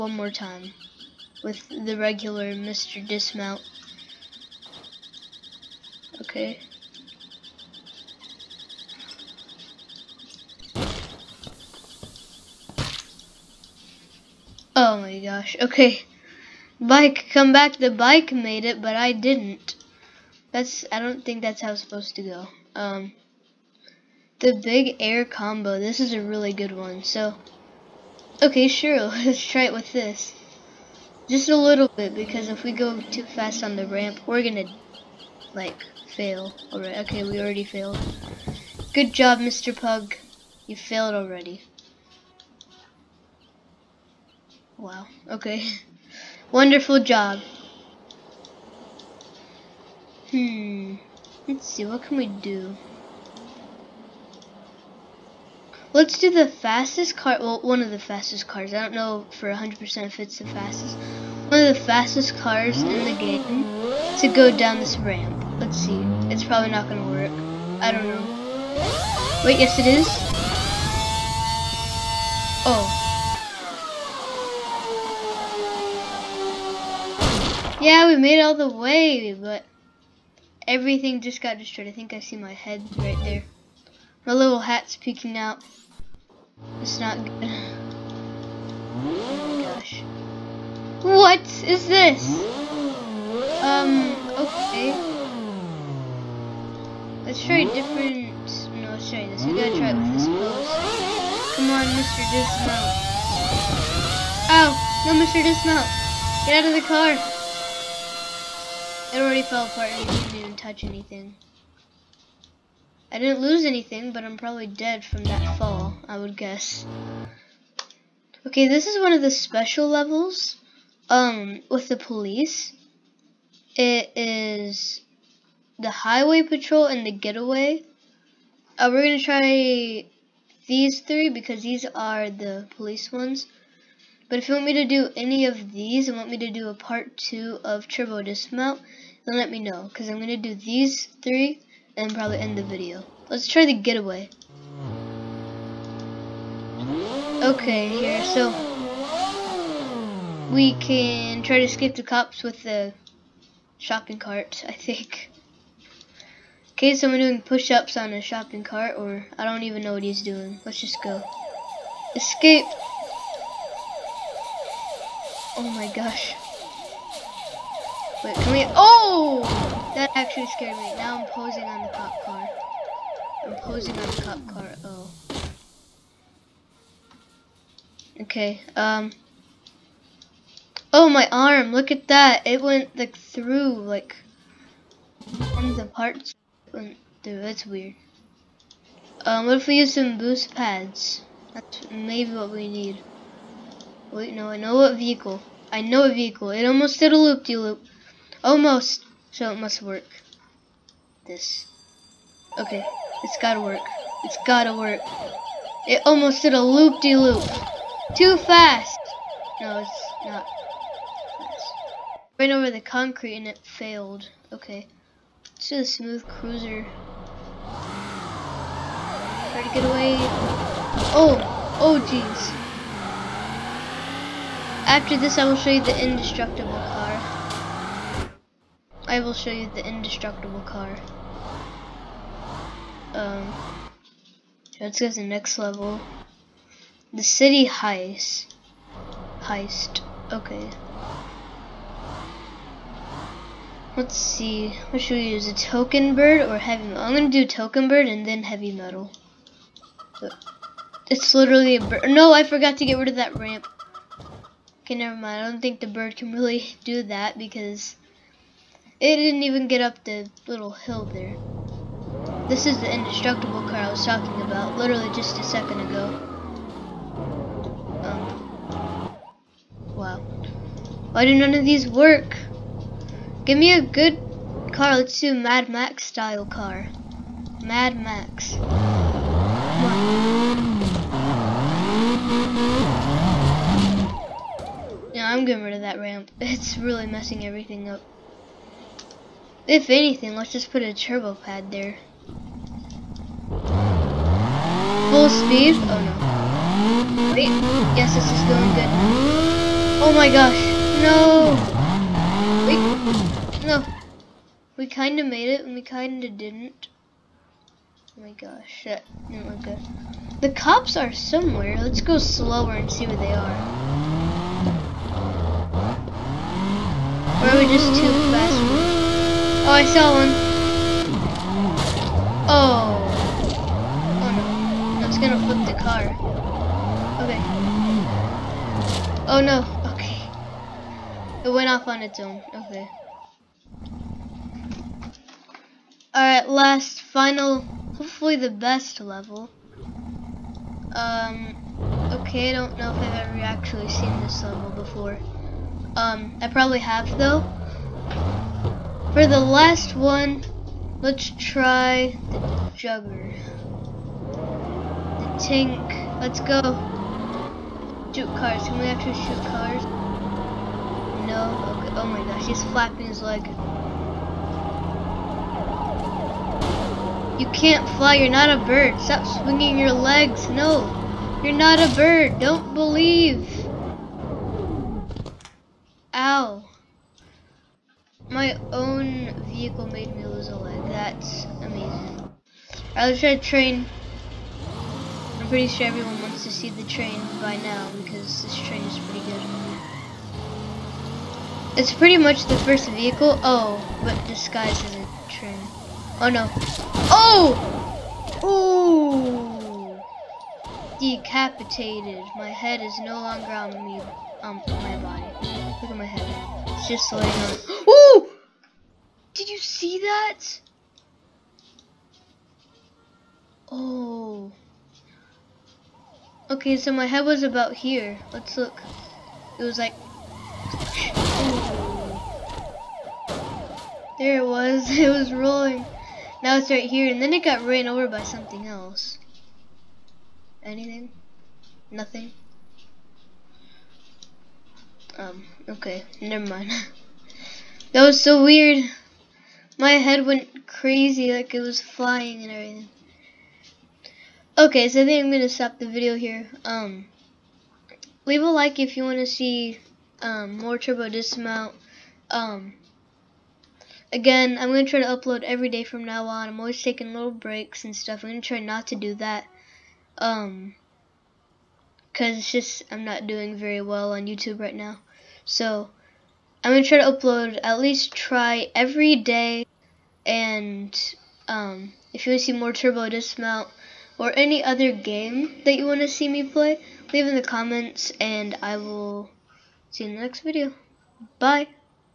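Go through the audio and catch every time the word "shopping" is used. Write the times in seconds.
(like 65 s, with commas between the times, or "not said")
153 s, 158 s.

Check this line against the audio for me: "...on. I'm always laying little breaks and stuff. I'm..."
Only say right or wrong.
wrong.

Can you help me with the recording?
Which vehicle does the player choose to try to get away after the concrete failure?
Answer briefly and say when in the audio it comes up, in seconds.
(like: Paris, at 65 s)
smooth cruiser, at 215 s.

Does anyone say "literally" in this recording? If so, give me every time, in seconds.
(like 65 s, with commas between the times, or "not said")
251 s, 264 s.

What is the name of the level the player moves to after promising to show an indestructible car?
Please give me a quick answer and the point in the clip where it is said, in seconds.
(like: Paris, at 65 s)
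city heist, at 237 s.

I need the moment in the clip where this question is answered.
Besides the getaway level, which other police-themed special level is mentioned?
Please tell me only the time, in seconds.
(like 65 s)
125 s.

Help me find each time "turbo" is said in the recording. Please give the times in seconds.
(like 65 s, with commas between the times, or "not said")
137 s, 290 s, 450 s, 472 s.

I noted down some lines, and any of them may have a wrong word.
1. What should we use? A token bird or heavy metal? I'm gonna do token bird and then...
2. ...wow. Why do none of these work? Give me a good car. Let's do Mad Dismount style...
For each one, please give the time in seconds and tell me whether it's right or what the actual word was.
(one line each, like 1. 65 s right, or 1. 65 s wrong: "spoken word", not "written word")
1. 244 s right
2. 269 s wrong: "Max", not "Dismount".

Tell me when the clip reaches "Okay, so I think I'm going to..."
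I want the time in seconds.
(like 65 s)
444 s.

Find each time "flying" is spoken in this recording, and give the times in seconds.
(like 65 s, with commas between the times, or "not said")
441 s.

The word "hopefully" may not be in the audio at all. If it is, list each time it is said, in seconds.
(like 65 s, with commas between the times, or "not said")
337 s.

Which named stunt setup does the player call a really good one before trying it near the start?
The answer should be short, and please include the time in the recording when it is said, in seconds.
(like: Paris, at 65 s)
big air combo, at 24 s.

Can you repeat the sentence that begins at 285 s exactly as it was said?
Yeah, I'm getting rid of that ramp.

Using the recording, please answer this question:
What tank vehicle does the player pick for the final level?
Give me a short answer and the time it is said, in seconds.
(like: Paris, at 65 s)
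Jugger, at 352 s.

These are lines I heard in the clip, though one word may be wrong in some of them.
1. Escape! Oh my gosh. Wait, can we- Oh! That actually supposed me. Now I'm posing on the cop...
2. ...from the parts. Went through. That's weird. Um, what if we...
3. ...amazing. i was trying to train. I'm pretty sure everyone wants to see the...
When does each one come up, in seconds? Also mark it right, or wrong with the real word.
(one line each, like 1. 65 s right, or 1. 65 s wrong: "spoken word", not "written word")
1. 162 s wrong: "scared", not "supposed"
2. 185 s right
3. 381 s right.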